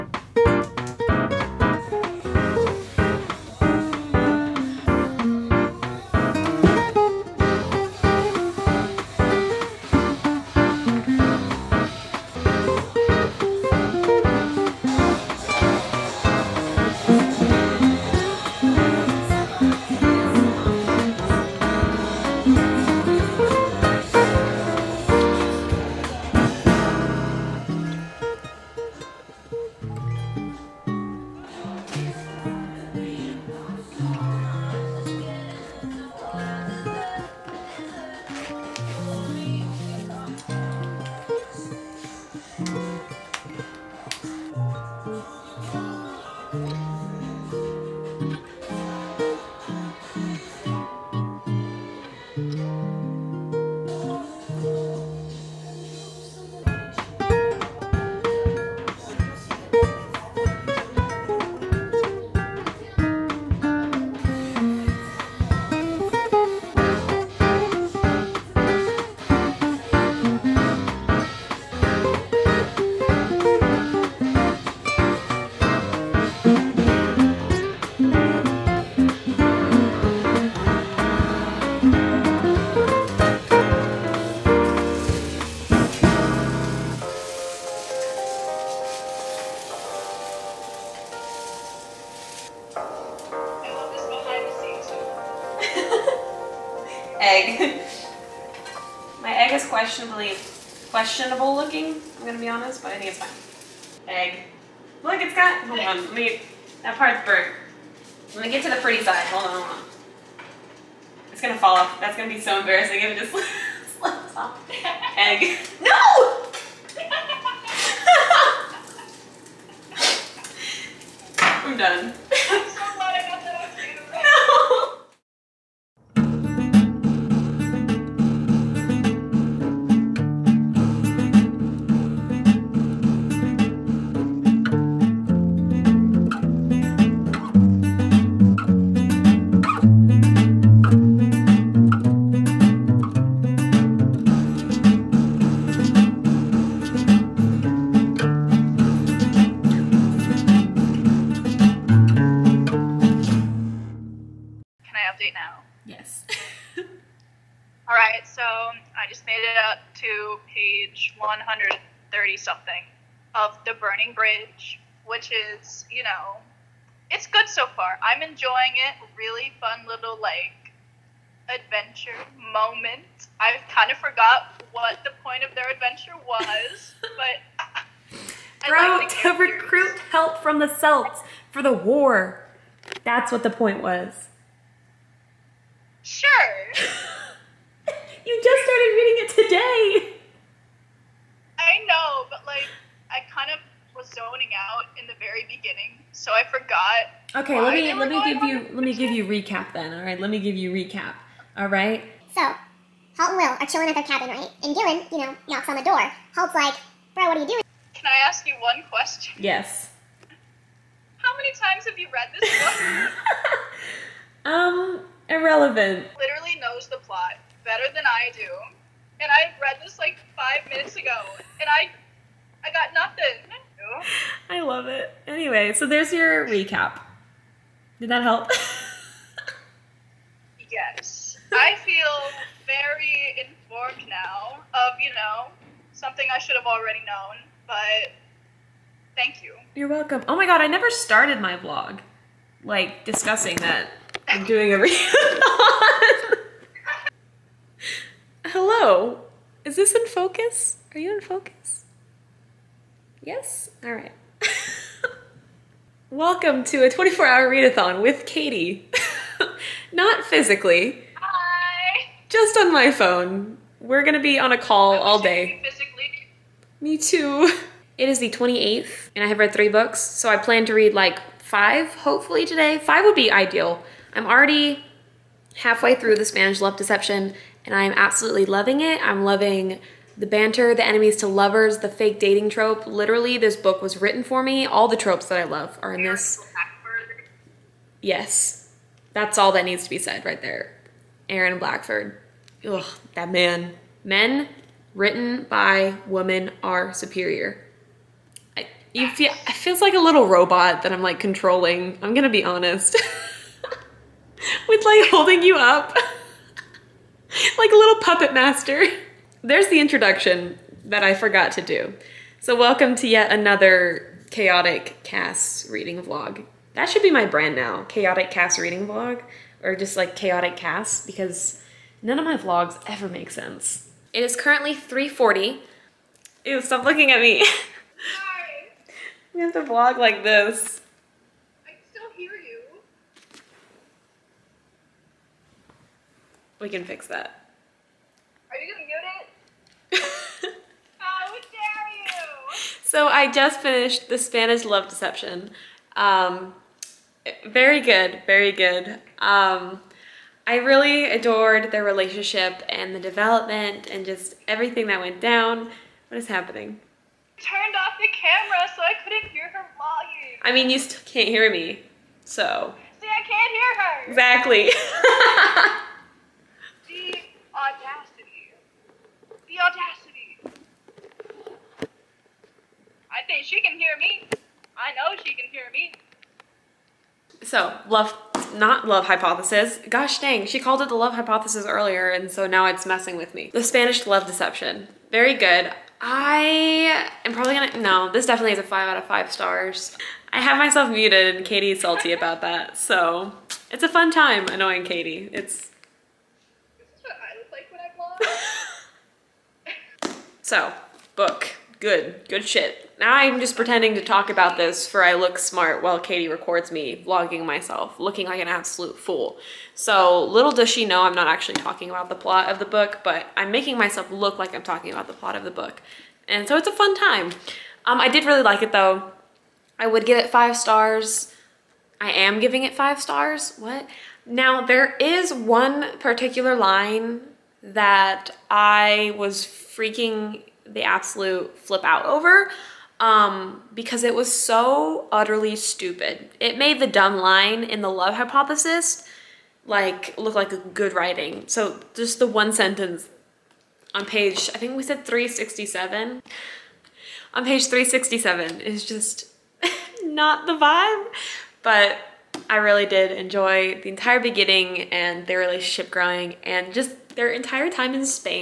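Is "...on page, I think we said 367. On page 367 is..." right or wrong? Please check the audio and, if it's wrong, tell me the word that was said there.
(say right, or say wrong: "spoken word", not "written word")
right.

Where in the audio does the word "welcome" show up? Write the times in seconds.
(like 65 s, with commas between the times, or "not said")
239 s, 256 s, 312 s.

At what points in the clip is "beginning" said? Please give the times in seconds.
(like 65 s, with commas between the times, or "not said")
195 s, 454 s.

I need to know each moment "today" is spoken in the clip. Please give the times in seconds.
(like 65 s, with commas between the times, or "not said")
189 s, 272 s.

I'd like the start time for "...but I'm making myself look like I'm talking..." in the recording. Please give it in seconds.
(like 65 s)
413 s.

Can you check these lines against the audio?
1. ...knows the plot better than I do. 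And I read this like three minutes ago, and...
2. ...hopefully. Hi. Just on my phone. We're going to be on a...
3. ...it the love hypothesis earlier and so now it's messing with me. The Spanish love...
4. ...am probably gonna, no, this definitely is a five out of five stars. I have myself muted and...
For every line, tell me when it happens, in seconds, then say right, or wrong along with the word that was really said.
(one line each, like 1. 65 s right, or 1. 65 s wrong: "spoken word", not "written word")
1. 216 s wrong: "five", not "three"
2. 260 s wrong: "physically", not "hopefully"
3. 380 s right
4. 387 s right.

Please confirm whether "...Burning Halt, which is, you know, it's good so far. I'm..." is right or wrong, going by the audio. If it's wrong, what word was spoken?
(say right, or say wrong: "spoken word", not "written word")
wrong: "Bridge", not "Halt".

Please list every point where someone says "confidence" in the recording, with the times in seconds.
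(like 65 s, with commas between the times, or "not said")
not said.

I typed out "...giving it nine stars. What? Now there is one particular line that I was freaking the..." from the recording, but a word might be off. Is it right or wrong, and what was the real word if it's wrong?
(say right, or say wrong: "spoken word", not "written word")
wrong: "five", not "nine".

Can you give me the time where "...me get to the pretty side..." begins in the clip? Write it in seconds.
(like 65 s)
108 s.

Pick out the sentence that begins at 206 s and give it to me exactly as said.
Halt's like, "Bro, what are you doing?" Can I ask you one question?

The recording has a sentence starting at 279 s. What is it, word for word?
I'm loving the banter, the enemies to lovers, the fake dating trope.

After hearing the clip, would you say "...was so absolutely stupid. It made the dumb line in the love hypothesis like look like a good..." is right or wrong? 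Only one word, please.
wrong.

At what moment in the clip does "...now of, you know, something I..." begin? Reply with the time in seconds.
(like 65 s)
234 s.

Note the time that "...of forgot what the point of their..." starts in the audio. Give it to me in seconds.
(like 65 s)
173 s.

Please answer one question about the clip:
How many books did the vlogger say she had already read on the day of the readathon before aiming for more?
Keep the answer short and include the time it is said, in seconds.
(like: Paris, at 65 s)
3, at 269 s.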